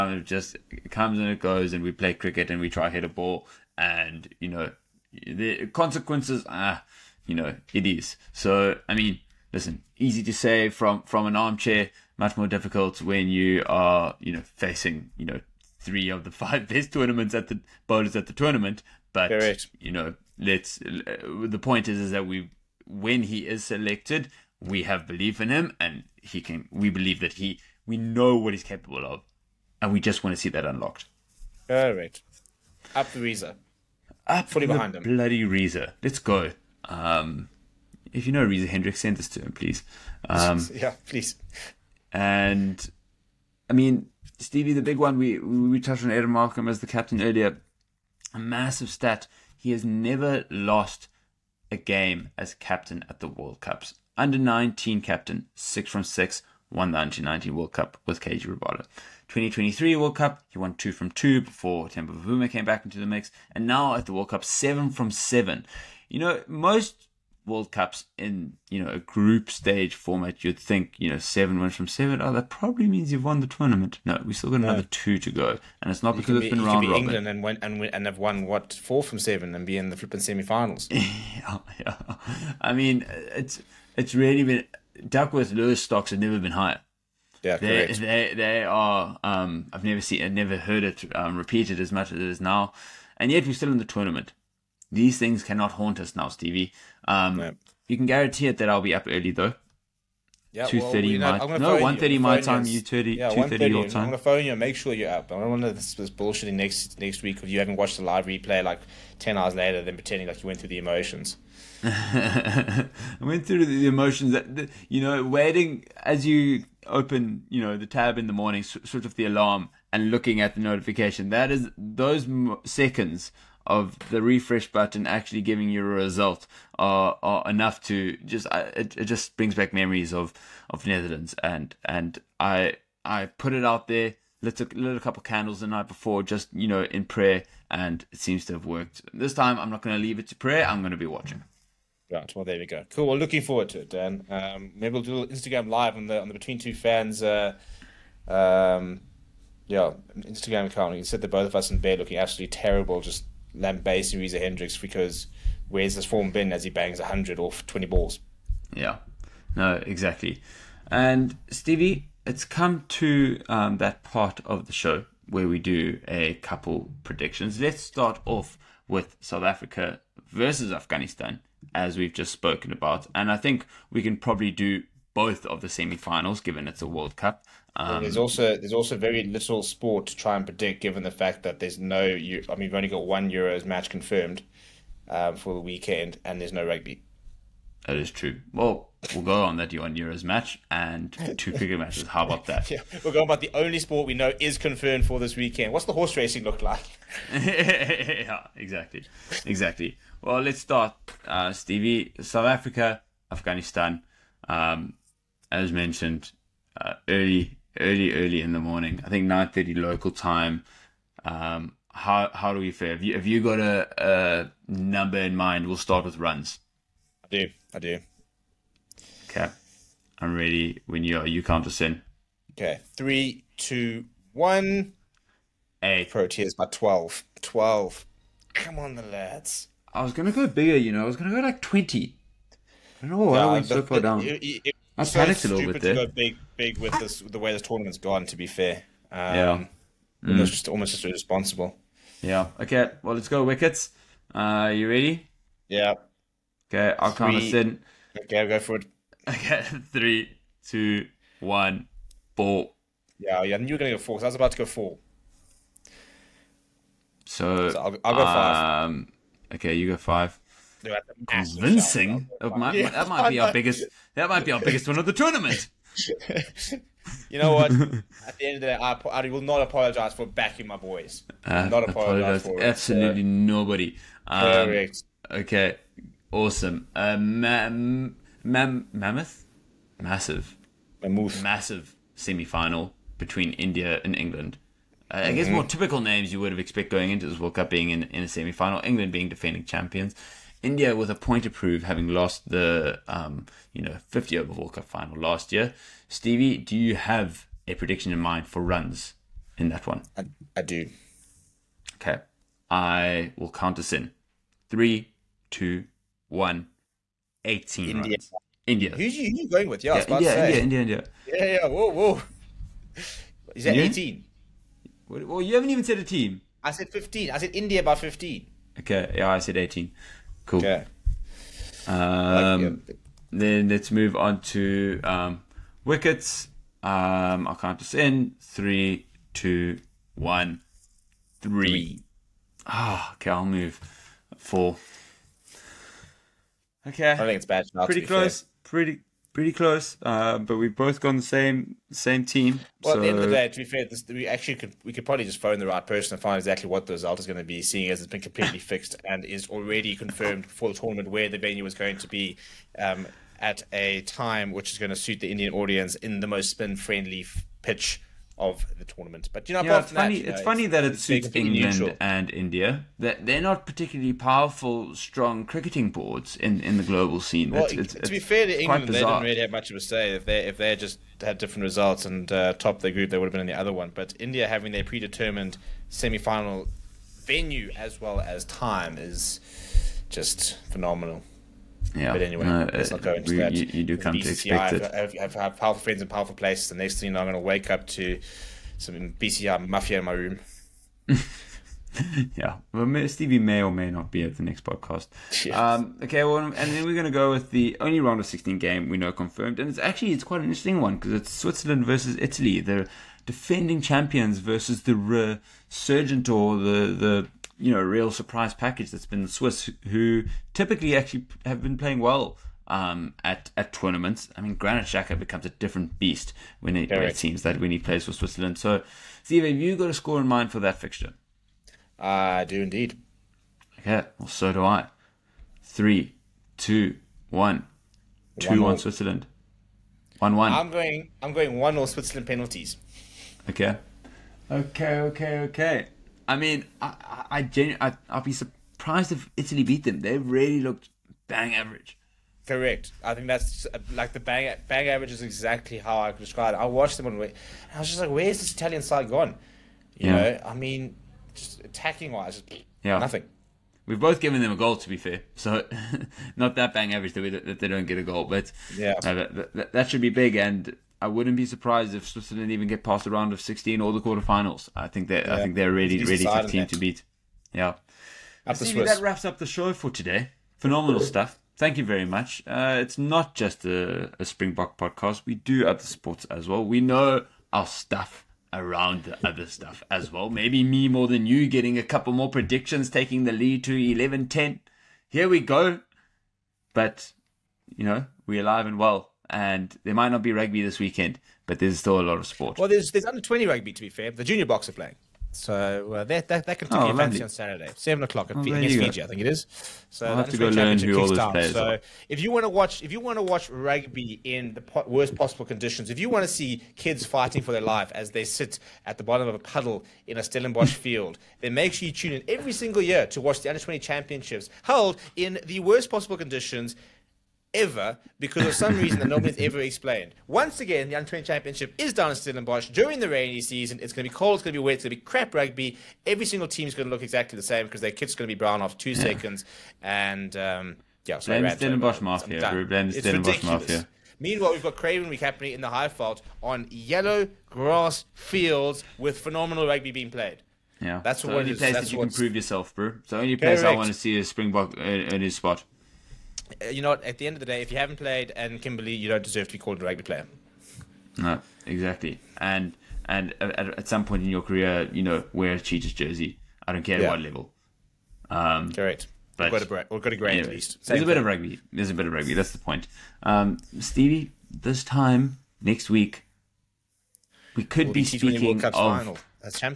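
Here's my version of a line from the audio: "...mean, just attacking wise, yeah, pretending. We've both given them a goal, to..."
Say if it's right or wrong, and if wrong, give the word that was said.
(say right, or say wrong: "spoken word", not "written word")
wrong: "nothing", not "pretending".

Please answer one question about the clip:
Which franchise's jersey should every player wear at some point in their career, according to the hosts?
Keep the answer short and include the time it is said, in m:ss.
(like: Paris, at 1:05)
Cheetahs, at 9:15.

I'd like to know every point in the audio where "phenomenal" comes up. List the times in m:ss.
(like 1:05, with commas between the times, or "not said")
6:20, 7:50, 8:59.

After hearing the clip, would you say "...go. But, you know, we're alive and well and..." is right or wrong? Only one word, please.
right.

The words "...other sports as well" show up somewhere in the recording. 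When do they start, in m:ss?
7:55.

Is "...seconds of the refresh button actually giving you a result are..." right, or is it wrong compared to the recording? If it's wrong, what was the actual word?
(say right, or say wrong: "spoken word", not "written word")
right.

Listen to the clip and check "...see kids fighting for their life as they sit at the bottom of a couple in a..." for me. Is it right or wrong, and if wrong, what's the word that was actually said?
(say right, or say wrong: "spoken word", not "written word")
wrong: "puddle", not "couple".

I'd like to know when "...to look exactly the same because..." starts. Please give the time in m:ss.
8:46.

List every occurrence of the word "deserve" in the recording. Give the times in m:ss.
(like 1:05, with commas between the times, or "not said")
9:09.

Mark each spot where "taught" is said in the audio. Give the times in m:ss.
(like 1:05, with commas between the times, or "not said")
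not said.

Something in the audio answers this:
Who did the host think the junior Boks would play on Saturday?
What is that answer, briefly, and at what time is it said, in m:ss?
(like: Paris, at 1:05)
Fiji, at 8:18.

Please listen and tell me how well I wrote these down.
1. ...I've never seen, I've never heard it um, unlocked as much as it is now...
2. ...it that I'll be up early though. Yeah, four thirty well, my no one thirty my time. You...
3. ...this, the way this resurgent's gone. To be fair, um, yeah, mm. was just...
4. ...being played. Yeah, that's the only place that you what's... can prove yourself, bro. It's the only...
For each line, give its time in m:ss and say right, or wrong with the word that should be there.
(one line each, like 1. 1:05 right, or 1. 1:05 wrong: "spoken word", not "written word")
1. 1:29 wrong: "repeated", not "unlocked"
2. 1:38 wrong: "two", not "four"
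3. 3:56 wrong: "tournament", not "resurgent"
4. 8:59 right.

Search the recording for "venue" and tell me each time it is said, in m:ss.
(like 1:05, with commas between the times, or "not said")
5:51, 6:17.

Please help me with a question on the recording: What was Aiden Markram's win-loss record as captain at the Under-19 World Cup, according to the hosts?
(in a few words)
6 from 6.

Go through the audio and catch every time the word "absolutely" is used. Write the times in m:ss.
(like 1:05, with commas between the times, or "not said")
2:32, 4:32.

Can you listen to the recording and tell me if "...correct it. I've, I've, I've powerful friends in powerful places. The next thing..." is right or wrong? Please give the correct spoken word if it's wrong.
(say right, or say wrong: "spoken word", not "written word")
wrong: "expect", not "correct".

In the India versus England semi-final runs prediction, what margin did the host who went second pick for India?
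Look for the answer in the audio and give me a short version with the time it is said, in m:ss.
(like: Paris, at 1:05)
15, at 5:17.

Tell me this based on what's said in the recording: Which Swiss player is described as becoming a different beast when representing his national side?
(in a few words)
Granit Xhaka.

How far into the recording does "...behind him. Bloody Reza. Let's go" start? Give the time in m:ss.
0:34.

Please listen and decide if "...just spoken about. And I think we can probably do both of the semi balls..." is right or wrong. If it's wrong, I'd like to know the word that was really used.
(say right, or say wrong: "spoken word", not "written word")
wrong: "finals", not "balls".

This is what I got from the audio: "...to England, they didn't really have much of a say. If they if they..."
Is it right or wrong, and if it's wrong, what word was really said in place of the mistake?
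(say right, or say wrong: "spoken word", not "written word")
right.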